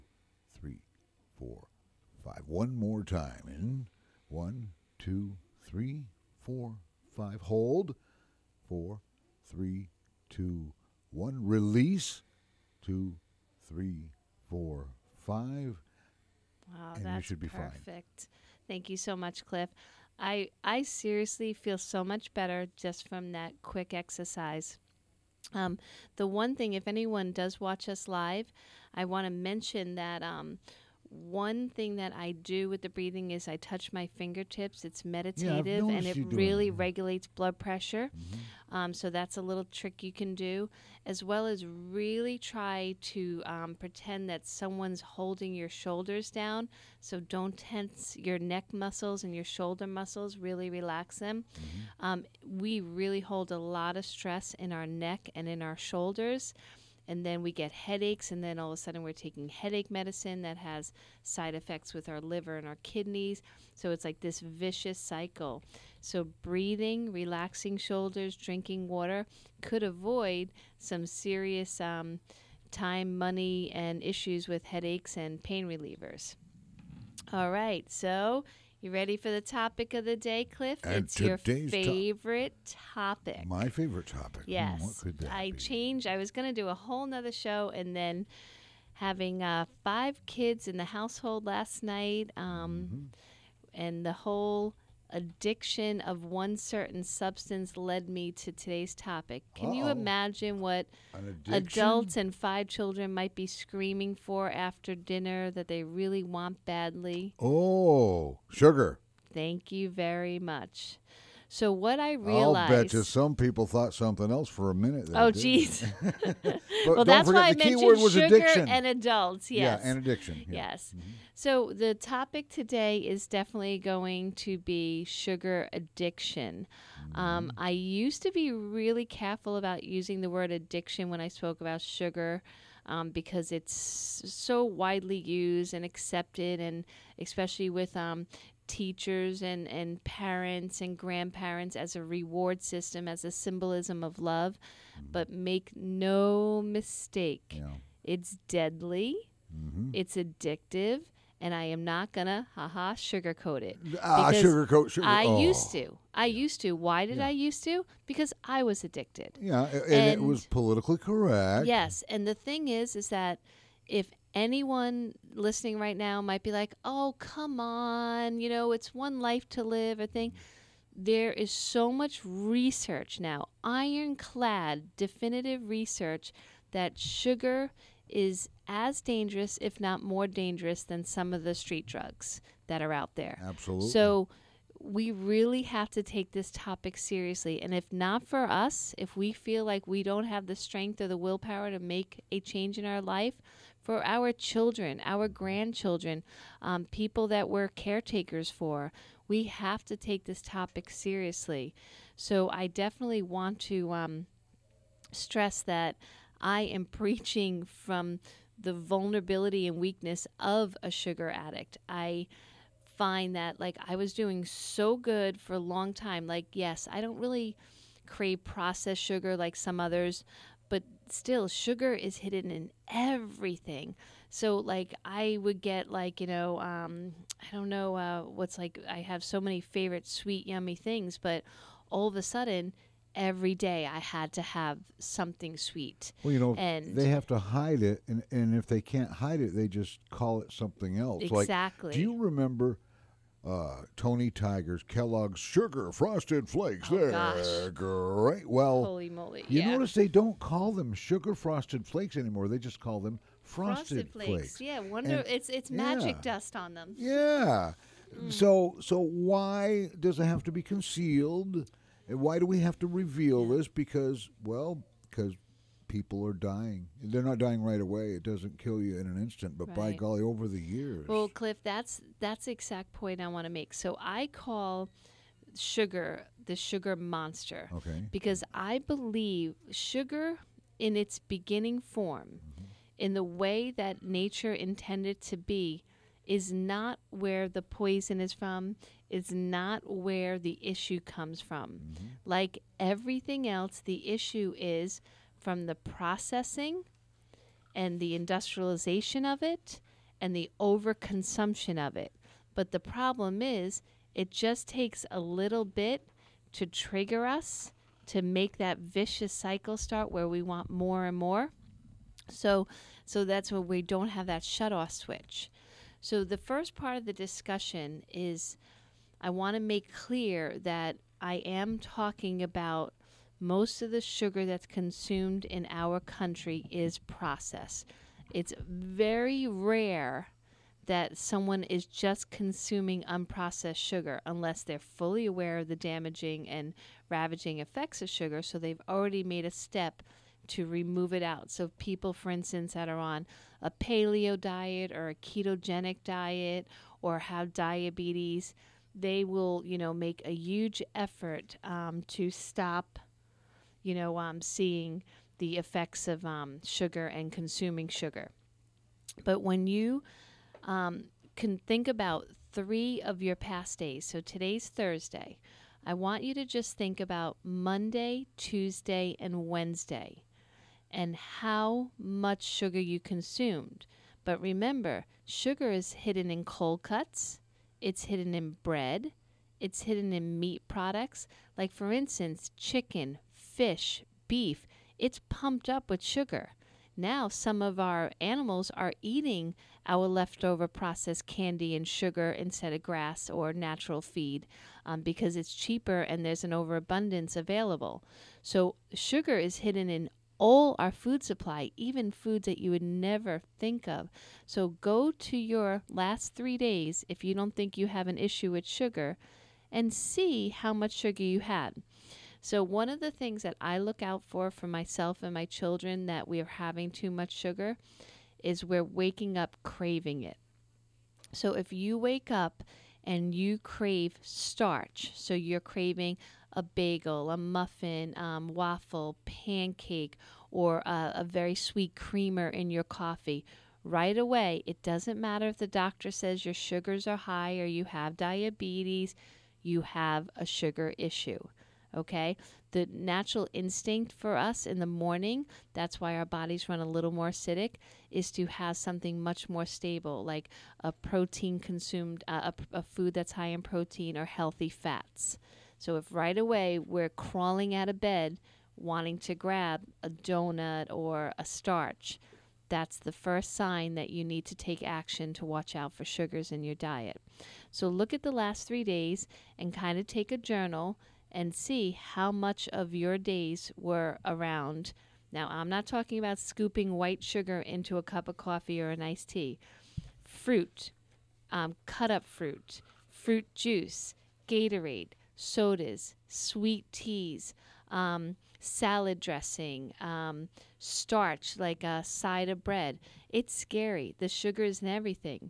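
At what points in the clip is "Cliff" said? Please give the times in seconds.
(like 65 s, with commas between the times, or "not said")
19 s, 80 s, 271 s.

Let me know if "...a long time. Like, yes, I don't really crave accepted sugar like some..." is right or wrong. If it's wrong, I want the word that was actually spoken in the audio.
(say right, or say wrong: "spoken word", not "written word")
wrong: "processed", not "accepted".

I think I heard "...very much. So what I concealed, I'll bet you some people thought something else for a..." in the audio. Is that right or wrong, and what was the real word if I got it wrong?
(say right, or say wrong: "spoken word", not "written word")
wrong: "realized", not "concealed".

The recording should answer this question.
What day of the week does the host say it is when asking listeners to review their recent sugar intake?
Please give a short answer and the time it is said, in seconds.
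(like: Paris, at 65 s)
Thursday, at 364 s.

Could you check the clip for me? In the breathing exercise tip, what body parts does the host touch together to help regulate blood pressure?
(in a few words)
fingertips.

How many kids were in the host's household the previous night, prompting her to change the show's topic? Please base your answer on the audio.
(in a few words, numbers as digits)
5.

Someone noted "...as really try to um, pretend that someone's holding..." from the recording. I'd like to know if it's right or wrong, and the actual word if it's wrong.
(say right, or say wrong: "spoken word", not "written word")
right.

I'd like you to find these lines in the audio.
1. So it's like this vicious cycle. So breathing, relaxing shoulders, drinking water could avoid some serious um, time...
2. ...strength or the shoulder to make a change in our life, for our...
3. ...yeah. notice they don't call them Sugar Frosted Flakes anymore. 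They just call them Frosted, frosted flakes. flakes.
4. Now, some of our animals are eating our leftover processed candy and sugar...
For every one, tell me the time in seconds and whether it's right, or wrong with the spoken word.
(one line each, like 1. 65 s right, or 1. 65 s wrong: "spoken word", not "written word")
1. 63 s right
2. 190 s wrong: "willpower", not "shoulder"
3. 249 s right
4. 386 s right.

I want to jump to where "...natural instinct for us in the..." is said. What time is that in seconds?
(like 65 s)
442 s.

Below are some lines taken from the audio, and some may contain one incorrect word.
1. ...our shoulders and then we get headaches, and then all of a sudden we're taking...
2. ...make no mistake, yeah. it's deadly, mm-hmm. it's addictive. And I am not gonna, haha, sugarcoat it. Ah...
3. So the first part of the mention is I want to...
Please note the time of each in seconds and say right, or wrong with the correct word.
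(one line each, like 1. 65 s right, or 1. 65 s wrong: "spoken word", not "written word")
1. 55 s right
2. 145 s right
3. 315 s wrong: "discussion", not "mention".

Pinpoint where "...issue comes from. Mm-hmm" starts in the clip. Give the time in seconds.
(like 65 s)
290 s.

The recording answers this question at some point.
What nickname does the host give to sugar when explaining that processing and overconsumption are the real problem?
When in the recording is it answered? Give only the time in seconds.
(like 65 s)
276 s.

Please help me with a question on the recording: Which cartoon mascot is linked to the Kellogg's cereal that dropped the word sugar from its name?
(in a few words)
Tony Tiger.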